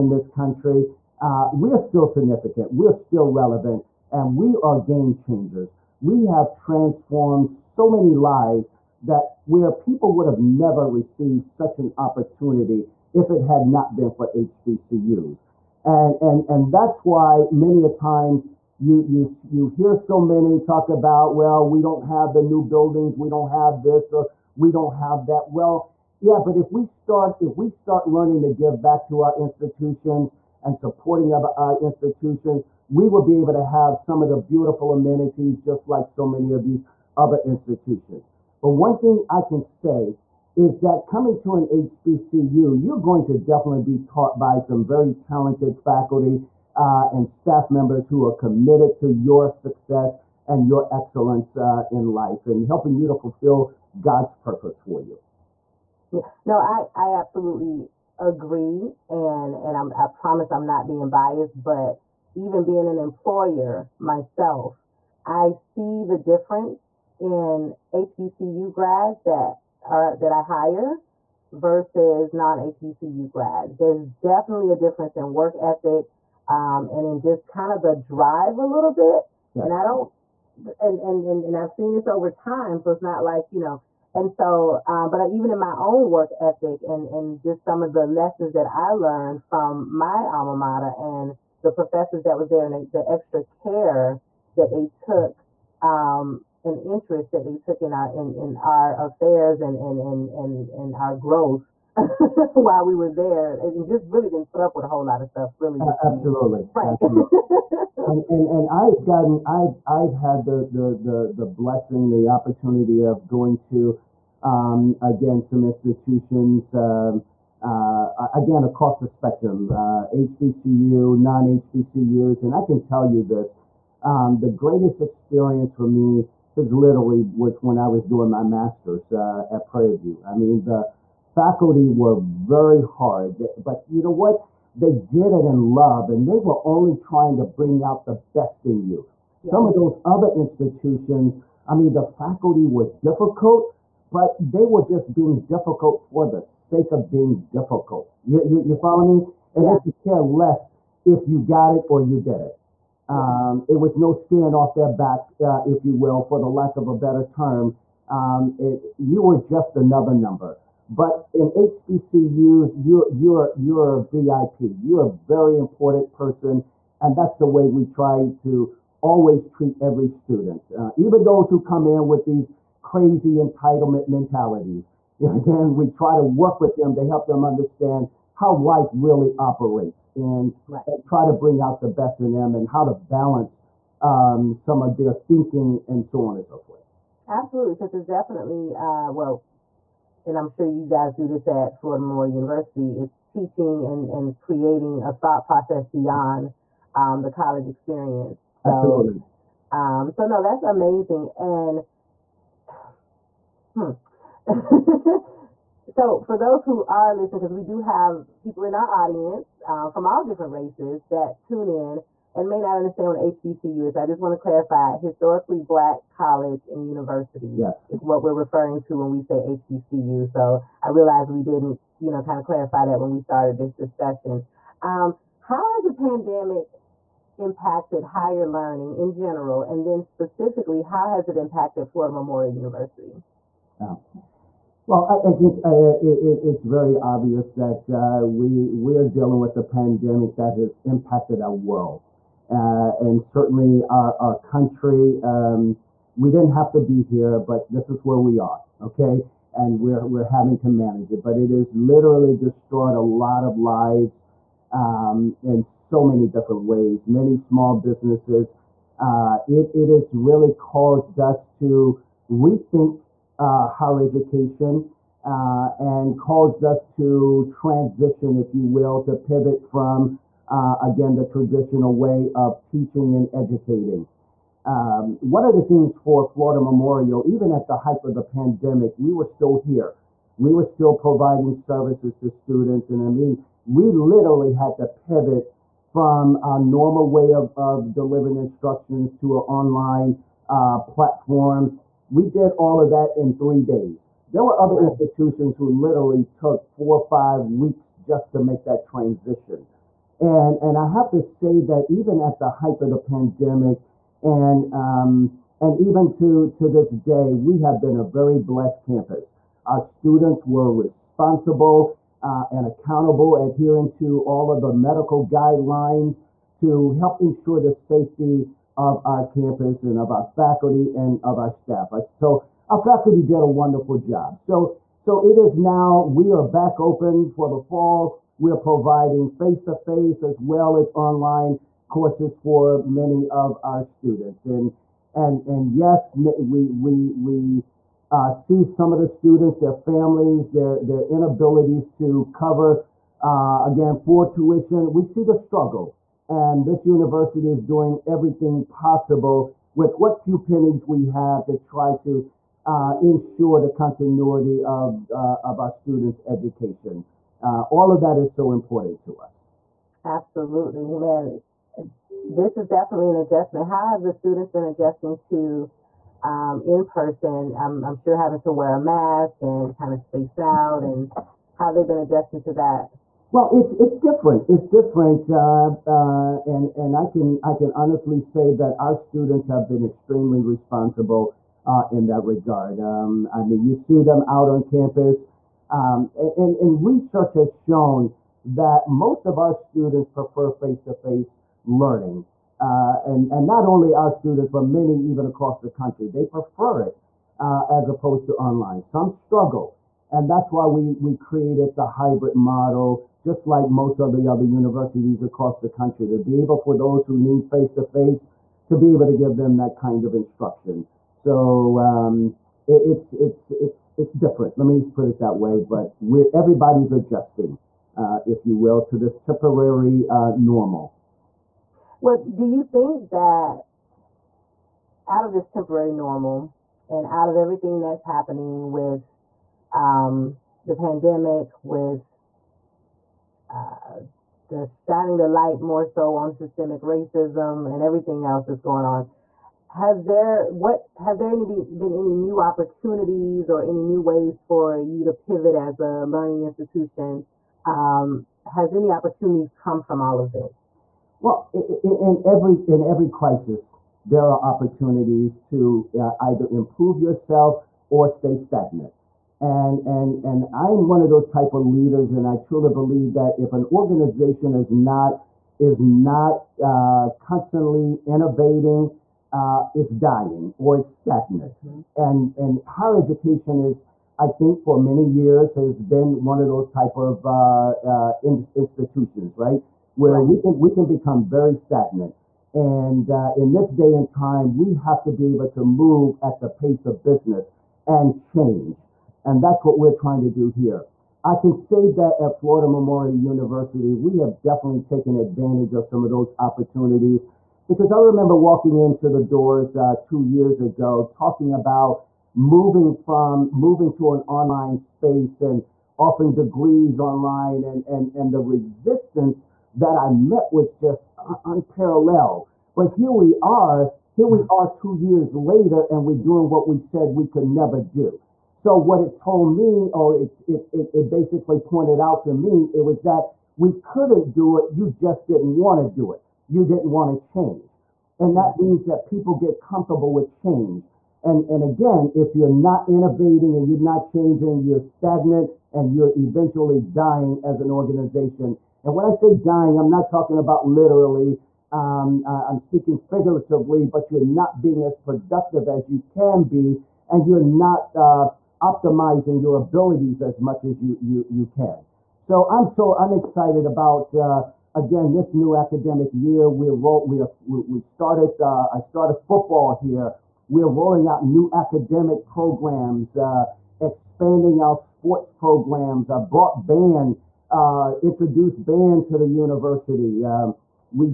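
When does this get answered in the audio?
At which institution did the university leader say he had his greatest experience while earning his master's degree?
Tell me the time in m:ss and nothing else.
2:09.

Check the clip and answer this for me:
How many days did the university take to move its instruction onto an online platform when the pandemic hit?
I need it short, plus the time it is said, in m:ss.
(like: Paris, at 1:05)
3, at 4:53.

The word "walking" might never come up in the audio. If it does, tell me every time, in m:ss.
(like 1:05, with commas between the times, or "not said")
8:18.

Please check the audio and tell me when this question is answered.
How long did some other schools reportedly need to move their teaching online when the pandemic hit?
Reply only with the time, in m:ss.
4:56.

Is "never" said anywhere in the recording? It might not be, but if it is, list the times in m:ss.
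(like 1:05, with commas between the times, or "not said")
0:10, 8:37.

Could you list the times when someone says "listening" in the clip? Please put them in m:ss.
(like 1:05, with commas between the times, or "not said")
3:27.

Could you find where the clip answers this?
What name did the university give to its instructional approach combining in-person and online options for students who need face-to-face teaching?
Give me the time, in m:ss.
6:41.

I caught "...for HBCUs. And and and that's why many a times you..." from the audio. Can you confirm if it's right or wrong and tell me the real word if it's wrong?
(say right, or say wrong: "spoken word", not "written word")
right.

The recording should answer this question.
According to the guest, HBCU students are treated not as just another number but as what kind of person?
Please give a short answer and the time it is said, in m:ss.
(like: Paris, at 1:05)
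VIP, at 2:44.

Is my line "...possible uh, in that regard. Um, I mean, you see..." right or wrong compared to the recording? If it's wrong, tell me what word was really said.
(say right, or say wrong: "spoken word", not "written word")
wrong: "responsible", not "possible".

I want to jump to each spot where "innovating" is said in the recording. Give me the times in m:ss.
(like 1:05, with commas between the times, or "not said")
7:48, 8:52.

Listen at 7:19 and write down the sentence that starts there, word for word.
Has there what has there any been any new opportunities or any new ways for you to pivot as a learning institution?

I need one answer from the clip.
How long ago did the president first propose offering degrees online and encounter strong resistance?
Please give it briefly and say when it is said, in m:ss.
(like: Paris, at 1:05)
2 years ago, at 8:20.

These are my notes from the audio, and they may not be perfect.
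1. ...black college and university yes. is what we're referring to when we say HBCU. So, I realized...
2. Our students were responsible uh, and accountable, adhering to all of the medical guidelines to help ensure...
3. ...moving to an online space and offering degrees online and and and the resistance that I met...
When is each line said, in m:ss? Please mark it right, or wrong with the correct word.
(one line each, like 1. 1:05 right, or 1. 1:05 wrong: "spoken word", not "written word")
1. 3:35 right
2. 5:09 right
3. 8:23 right.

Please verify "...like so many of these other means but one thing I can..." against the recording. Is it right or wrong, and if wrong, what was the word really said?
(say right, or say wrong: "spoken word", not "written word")
wrong: "institutions", not "means".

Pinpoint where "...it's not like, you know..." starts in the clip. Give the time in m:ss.
1:22.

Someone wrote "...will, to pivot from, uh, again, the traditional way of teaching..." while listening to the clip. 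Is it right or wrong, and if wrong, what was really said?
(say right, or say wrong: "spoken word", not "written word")
right.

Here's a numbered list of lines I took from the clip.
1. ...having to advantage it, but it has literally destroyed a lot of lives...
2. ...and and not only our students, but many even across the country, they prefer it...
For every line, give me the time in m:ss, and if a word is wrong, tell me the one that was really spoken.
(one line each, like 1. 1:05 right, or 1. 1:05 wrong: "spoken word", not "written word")
1. 4:10 wrong: "manage", not "advantage"
2. 6:33 right.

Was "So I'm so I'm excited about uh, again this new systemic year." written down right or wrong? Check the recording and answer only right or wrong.
wrong.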